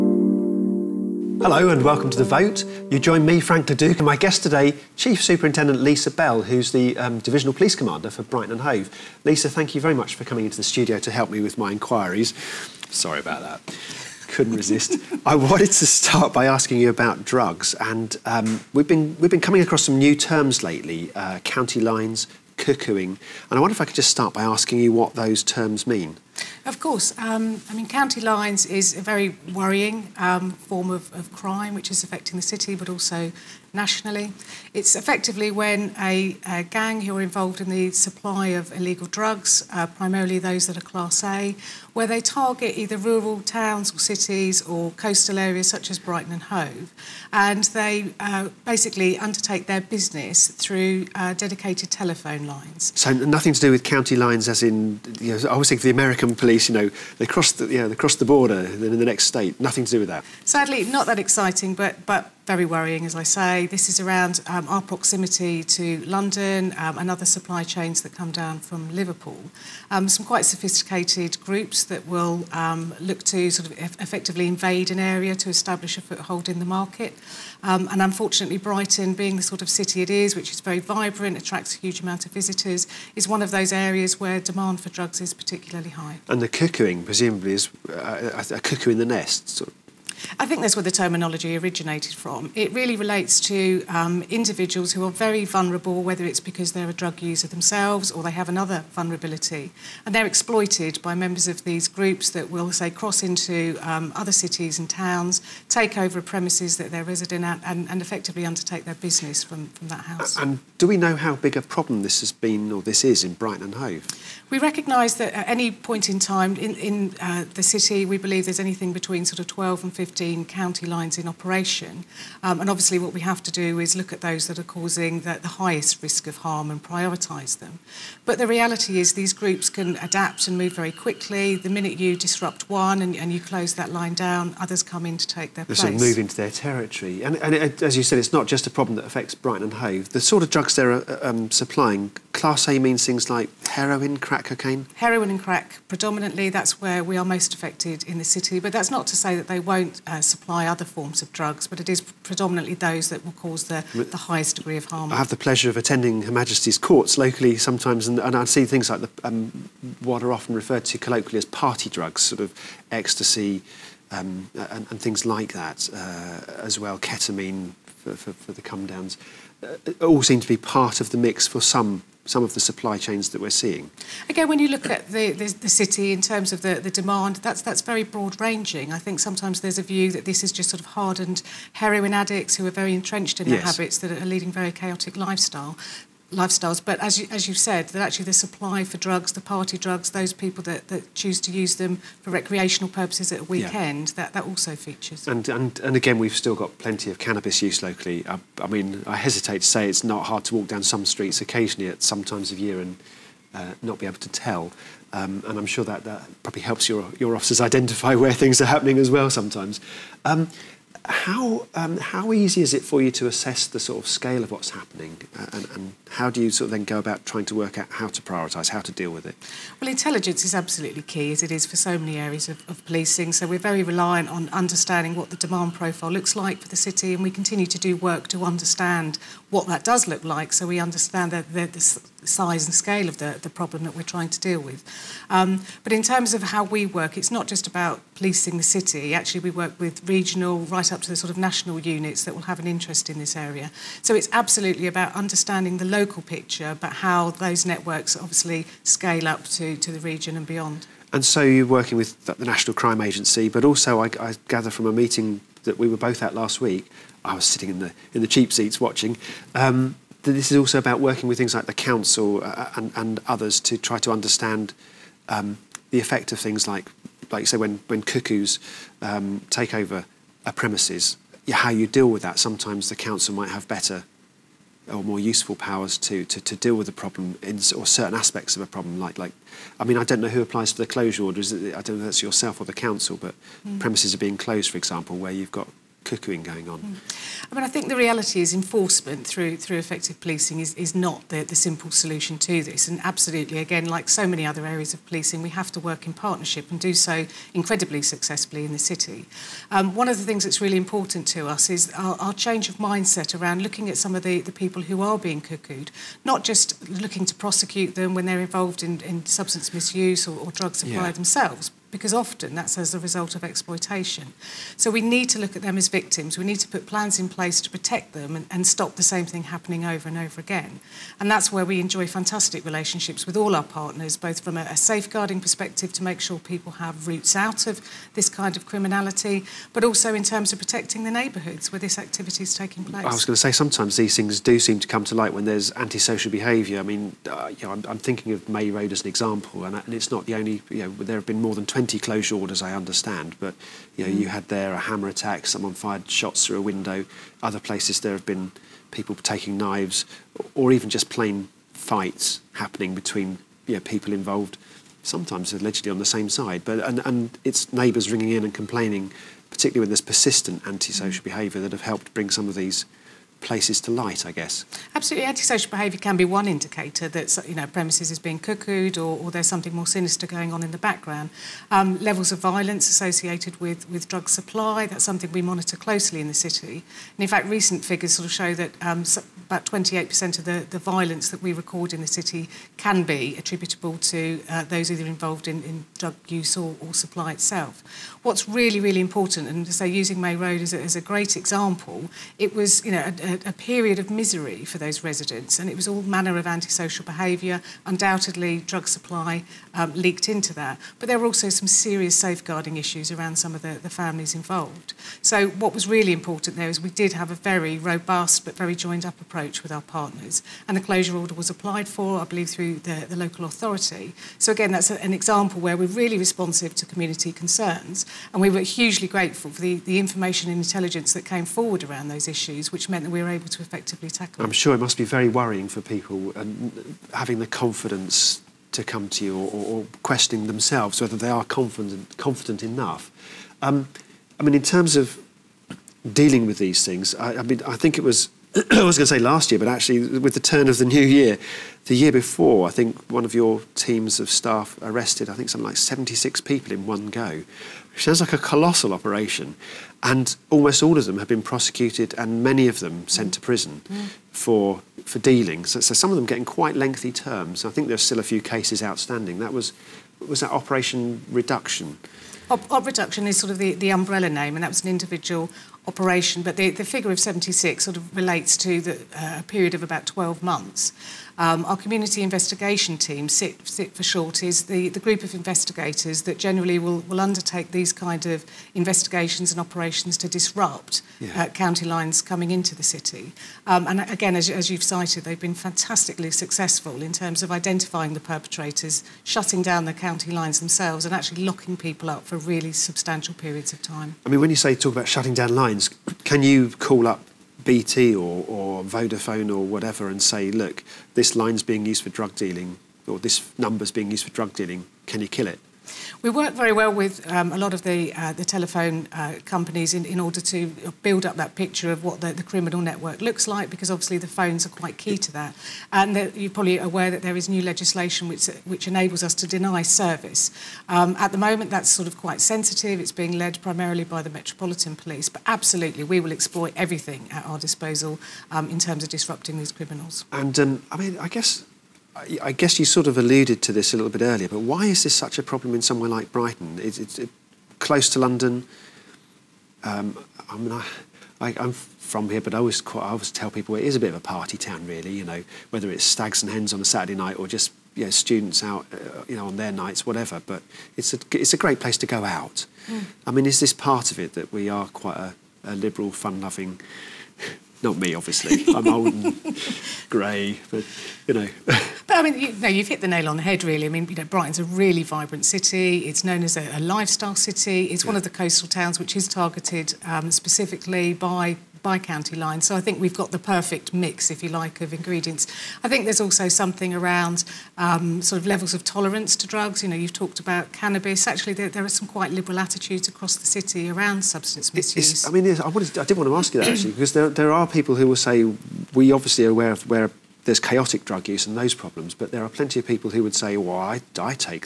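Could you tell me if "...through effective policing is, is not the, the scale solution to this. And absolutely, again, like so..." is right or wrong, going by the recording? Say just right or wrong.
wrong.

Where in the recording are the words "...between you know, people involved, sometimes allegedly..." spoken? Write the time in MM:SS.
05:52.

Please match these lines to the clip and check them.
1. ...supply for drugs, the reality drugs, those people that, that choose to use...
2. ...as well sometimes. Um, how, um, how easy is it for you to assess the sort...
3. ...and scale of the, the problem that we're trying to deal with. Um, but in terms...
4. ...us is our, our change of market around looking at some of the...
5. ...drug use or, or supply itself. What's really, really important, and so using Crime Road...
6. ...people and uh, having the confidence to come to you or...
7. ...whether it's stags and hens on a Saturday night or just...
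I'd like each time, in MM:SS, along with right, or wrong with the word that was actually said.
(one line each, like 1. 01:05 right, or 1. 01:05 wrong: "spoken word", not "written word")
1. 03:08 wrong: "party", not "reality"
2. 03:28 right
3. 03:52 right
4. 05:01 wrong: "mindset", not "market"
5. 06:25 wrong: "May", not "Crime"
6. 07:05 right
7. 09:05 right.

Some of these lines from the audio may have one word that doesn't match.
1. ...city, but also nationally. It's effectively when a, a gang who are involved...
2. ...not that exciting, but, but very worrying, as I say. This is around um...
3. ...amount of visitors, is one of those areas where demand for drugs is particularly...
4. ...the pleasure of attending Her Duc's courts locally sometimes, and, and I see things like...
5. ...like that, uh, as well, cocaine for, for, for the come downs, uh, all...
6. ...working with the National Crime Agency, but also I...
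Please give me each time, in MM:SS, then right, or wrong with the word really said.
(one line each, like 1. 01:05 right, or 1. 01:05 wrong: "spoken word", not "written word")
1. 00:32 right
2. 01:00 right
3. 01:21 right
4. 02:35 wrong: "Majesty", not "Duc"
5. 02:45 wrong: "ketamine", not "cocaine"
6. 04:11 right.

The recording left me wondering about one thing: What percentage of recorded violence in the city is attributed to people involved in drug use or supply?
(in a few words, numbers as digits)
28%.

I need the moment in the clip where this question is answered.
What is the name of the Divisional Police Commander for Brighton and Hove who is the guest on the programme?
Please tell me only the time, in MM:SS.
00:05.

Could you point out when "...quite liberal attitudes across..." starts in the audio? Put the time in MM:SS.
09:42.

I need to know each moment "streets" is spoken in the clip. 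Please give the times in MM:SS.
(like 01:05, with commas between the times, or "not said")
03:21.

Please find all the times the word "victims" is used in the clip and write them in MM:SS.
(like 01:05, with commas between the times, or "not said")
05:15.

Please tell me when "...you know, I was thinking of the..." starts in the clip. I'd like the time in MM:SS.
00:55.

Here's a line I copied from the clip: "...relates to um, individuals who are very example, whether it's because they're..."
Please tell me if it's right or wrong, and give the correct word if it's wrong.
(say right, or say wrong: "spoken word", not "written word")
wrong: "vulnerable", not "example".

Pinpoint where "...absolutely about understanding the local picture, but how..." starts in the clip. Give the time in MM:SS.
04:04.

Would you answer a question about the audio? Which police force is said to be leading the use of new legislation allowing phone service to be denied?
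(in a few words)
Metropolitan Police.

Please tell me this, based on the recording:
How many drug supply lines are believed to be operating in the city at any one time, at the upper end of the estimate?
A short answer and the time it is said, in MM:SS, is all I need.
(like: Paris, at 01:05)
15, at 02:00.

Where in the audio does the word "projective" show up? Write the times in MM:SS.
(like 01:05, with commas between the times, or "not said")
not said.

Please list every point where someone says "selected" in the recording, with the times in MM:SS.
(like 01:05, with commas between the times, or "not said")
not said.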